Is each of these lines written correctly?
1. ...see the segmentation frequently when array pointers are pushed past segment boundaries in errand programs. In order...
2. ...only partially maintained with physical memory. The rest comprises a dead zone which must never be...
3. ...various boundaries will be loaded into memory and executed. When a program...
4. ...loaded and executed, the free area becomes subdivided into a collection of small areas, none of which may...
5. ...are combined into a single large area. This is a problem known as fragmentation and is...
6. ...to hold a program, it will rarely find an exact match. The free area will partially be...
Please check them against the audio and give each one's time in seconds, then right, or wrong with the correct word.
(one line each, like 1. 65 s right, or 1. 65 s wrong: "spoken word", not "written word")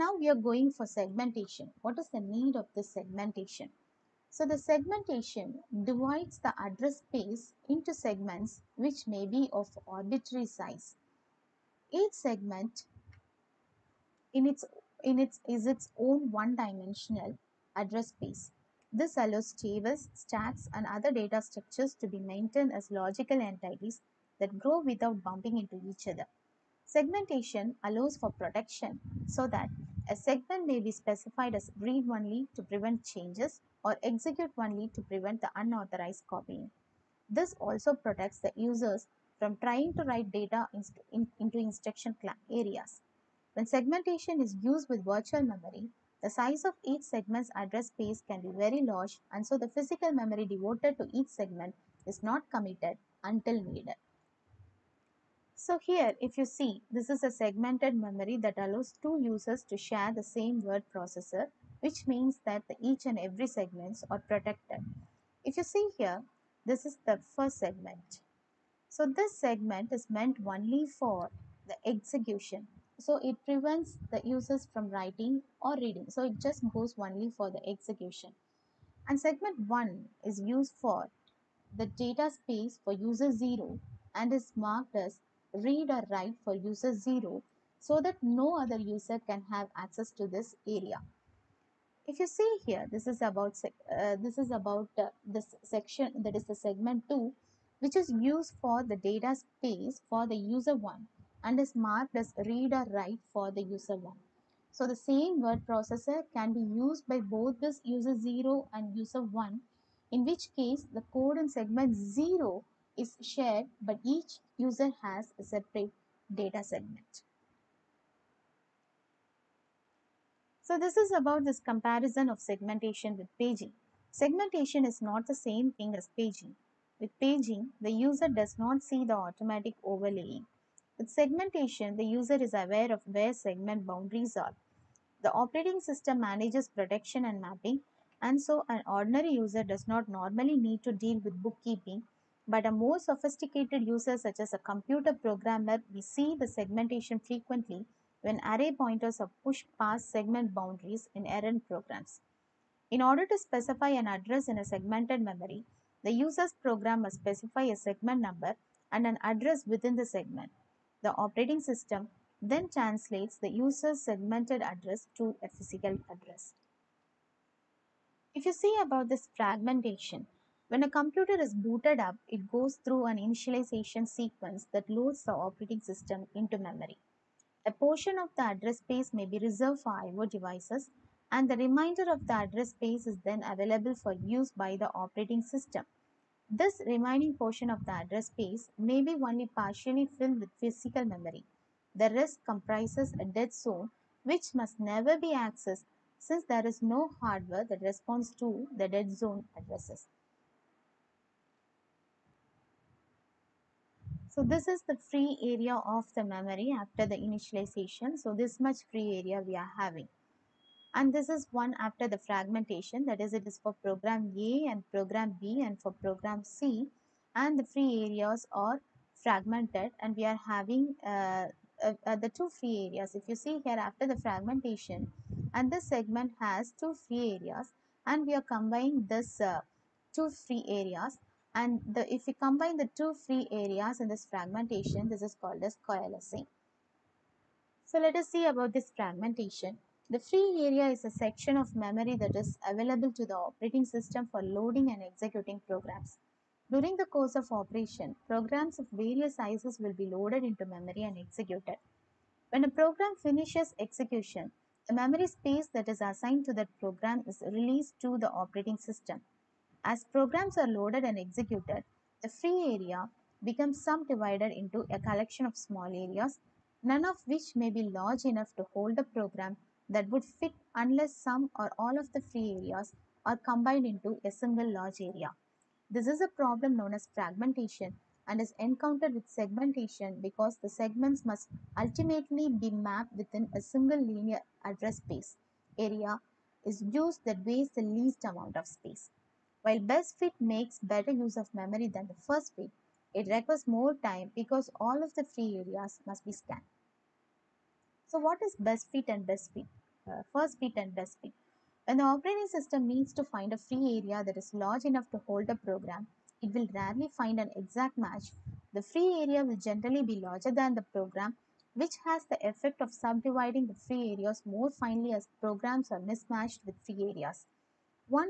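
1. 146 s right
2. 189 s wrong: "filled", not "maintained"
3. 248 s wrong: "sizes", not "boundaries"
4. 260 s right
5. 273 s right
6. 305 s wrong: "generally", not "partially".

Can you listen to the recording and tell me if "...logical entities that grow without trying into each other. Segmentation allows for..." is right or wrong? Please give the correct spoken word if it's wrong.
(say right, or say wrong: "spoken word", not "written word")
wrong: "bumping", not "trying".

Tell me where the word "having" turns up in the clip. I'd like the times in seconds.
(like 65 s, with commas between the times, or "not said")
209 s, 220 s.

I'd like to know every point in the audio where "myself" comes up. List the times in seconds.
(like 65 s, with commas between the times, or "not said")
not said.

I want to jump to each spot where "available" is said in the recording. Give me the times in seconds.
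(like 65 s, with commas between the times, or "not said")
183 s, 242 s.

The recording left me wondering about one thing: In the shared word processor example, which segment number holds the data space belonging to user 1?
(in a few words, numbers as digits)
Segment 2.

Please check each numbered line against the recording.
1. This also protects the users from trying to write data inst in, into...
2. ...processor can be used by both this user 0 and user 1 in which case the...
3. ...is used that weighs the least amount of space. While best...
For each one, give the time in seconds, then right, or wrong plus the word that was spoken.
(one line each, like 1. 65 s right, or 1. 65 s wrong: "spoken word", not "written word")
1. 37 s right
2. 105 s right
3. 286 s right.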